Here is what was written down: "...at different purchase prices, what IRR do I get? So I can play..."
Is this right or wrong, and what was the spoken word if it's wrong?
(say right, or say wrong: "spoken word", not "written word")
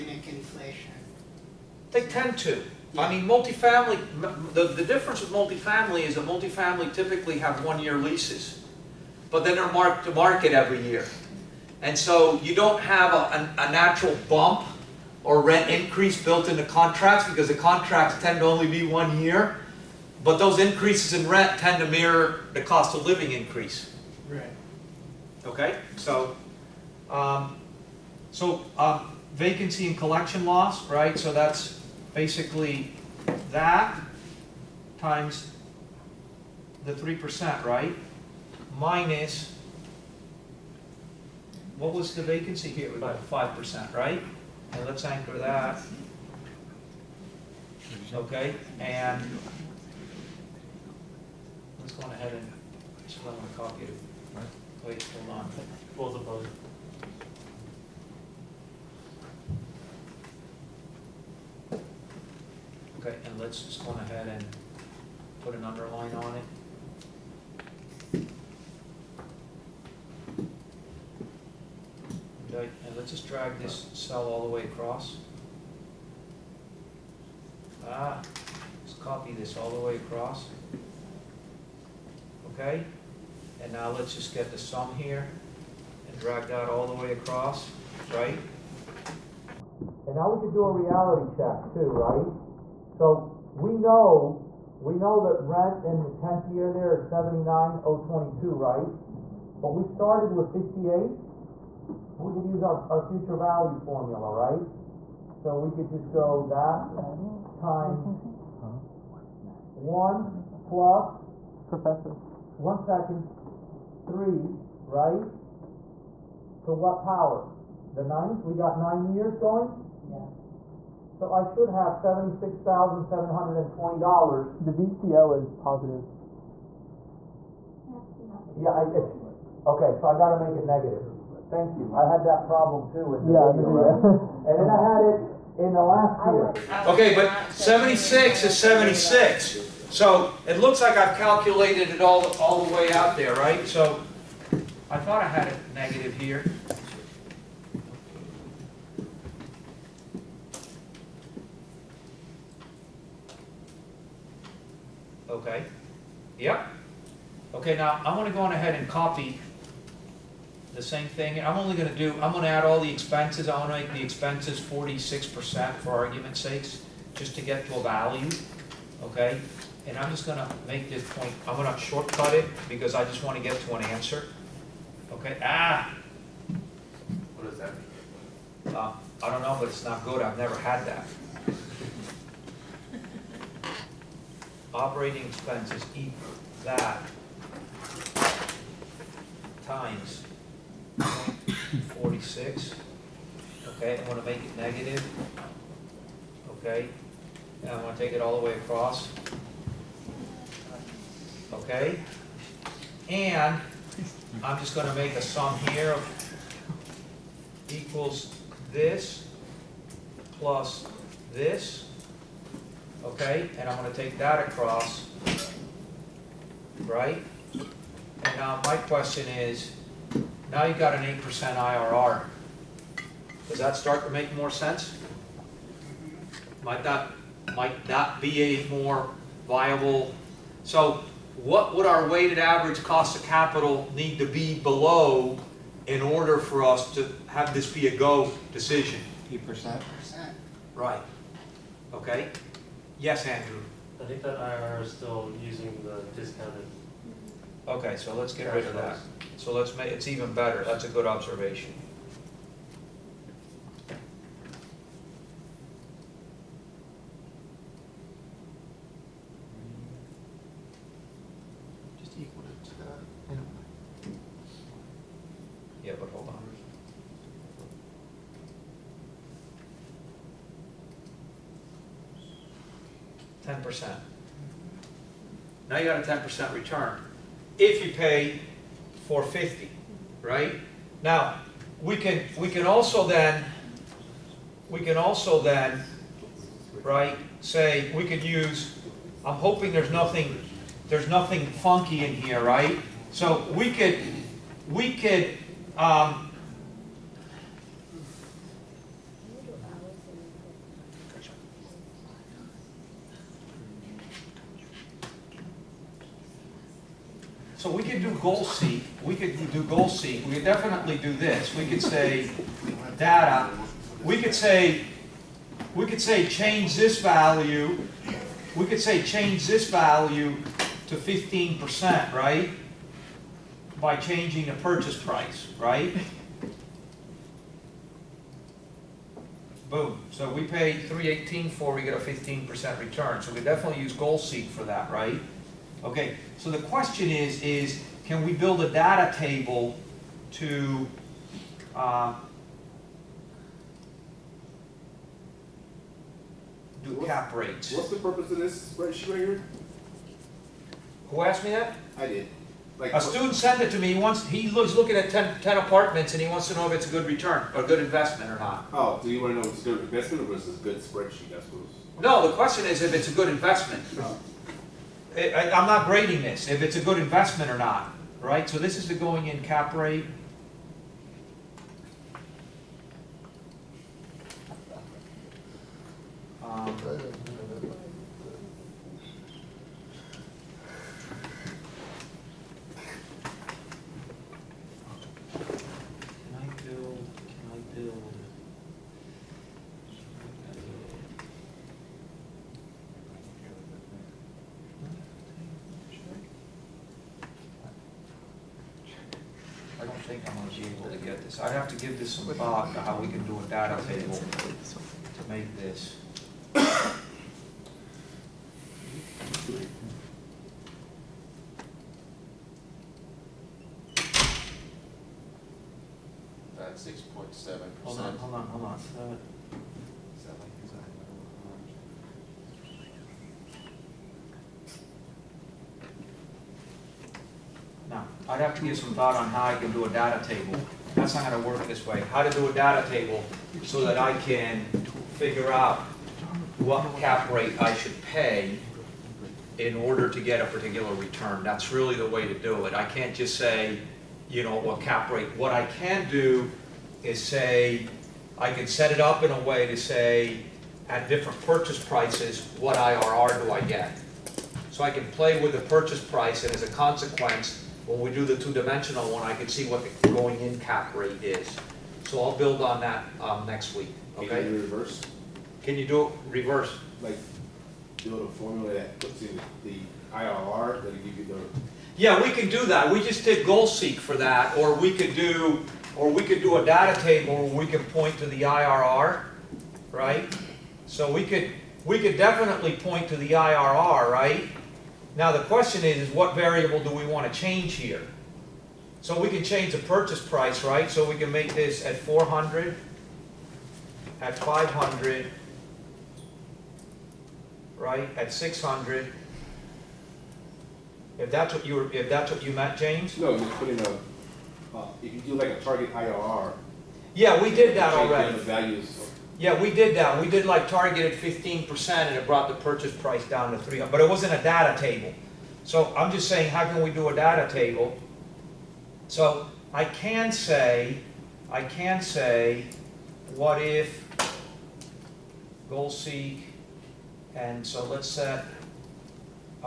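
right.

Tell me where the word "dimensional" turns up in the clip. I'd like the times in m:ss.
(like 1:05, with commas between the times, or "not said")
7:38.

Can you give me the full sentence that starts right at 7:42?
So I'll build on that um, next week, okay?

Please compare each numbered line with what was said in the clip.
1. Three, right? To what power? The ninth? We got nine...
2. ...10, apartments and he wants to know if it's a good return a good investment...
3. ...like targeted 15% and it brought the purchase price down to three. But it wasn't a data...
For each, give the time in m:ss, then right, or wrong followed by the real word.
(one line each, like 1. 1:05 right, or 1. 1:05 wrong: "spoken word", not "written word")
1. 1:54 right
2. 5:55 right
3. 8:30 right.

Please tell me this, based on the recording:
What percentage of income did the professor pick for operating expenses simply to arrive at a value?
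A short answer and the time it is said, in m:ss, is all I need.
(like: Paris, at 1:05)
46%, at 2:44.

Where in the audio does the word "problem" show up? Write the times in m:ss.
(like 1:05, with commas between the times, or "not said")
2:12.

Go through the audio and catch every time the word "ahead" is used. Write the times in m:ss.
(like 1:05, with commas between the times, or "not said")
0:52, 1:03, 2:38.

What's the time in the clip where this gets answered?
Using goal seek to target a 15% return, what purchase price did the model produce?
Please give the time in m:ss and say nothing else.
5:30.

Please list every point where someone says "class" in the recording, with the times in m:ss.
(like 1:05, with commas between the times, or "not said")
not said.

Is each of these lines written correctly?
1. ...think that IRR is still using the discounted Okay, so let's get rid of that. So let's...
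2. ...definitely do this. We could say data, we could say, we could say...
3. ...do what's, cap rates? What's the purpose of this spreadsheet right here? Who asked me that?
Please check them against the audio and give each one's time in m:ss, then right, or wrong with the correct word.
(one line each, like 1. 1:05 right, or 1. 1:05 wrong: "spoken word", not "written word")
1. 4:04 right
2. 5:10 right
3. 5:46 right.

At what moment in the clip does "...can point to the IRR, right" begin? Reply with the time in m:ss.
7:57.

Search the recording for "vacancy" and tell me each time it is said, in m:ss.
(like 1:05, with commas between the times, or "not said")
0:29, 0:42.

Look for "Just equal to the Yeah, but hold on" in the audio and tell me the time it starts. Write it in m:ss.
4:21.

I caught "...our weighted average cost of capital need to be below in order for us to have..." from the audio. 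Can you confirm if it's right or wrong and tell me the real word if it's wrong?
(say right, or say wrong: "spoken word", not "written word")
right.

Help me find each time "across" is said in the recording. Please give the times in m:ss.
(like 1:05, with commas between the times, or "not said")
1:14, 1:19, 1:27, 3:18, 3:34.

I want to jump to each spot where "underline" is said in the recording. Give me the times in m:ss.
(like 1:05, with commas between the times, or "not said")
1:05.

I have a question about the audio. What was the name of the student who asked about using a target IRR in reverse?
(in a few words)
James.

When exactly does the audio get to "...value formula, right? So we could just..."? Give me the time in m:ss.
1:43.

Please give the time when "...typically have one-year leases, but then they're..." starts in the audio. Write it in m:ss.
0:06.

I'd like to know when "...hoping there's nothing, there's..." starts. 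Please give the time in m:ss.
4:49.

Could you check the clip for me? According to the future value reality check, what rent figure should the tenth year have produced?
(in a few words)
$76,720.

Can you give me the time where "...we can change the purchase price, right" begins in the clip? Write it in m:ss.
8:09.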